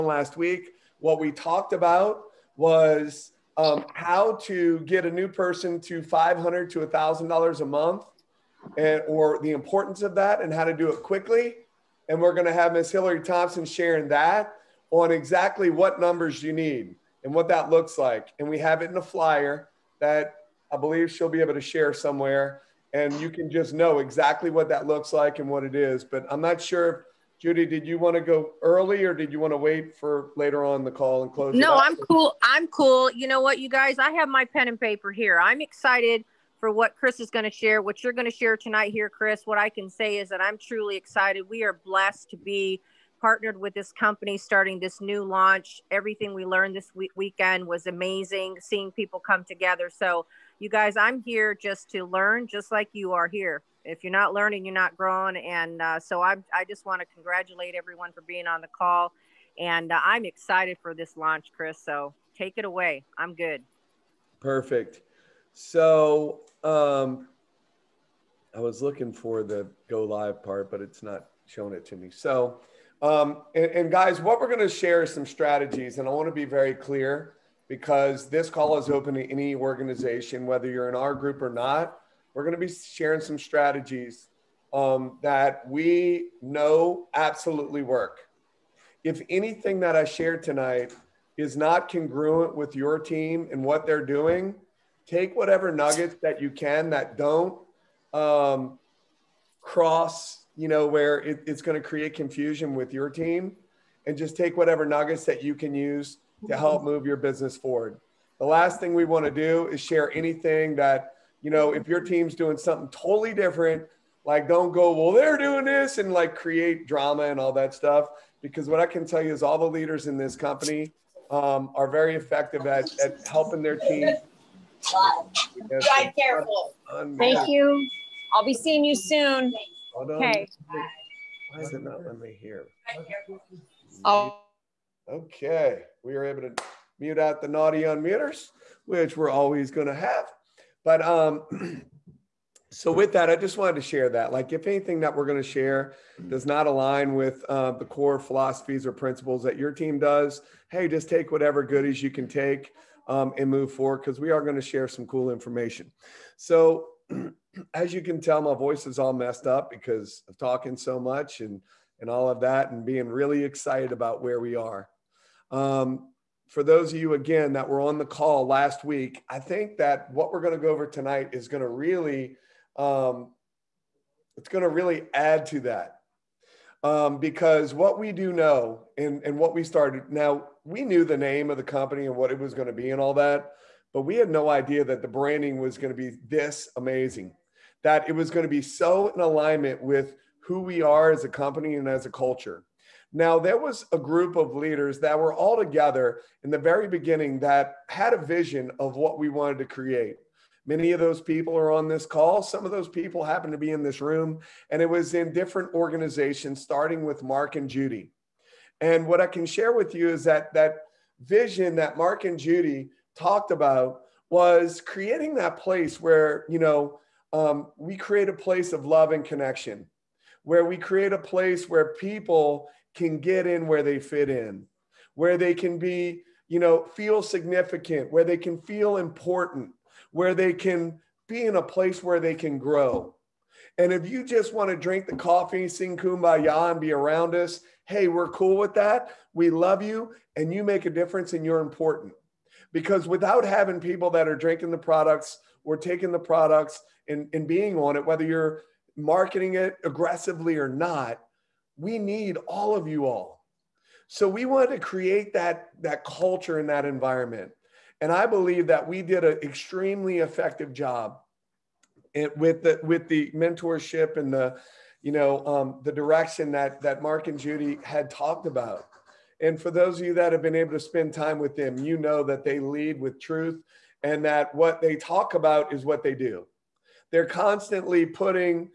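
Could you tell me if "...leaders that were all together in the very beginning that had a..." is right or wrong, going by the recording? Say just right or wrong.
right.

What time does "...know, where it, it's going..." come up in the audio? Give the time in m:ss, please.
1:40.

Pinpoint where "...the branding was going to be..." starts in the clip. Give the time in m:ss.
3:05.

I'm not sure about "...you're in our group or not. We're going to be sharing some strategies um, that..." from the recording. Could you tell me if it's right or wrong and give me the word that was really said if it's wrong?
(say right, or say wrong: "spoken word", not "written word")
right.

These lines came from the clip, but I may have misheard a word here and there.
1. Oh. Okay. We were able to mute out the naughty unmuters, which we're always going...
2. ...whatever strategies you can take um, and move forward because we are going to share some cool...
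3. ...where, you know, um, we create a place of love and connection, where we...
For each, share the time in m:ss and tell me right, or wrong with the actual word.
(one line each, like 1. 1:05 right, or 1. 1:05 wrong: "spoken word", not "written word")
1. 2:14 right
2. 2:31 wrong: "goodies", not "strategies"
3. 3:36 right.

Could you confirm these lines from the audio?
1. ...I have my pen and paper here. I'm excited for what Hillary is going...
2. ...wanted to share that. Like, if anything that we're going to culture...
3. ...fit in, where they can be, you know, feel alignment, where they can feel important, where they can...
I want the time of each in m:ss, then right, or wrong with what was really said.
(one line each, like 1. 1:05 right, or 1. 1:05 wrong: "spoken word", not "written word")
1. 0:33 wrong: "Chris", not "Hillary"
2. 2:23 wrong: "share", not "culture"
3. 3:43 wrong: "significant", not "alignment".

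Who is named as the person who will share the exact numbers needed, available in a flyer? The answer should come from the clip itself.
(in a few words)
Hillary Thompson.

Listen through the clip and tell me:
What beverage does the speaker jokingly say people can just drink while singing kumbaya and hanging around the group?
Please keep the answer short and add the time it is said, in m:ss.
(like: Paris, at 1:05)
coffee, at 3:55.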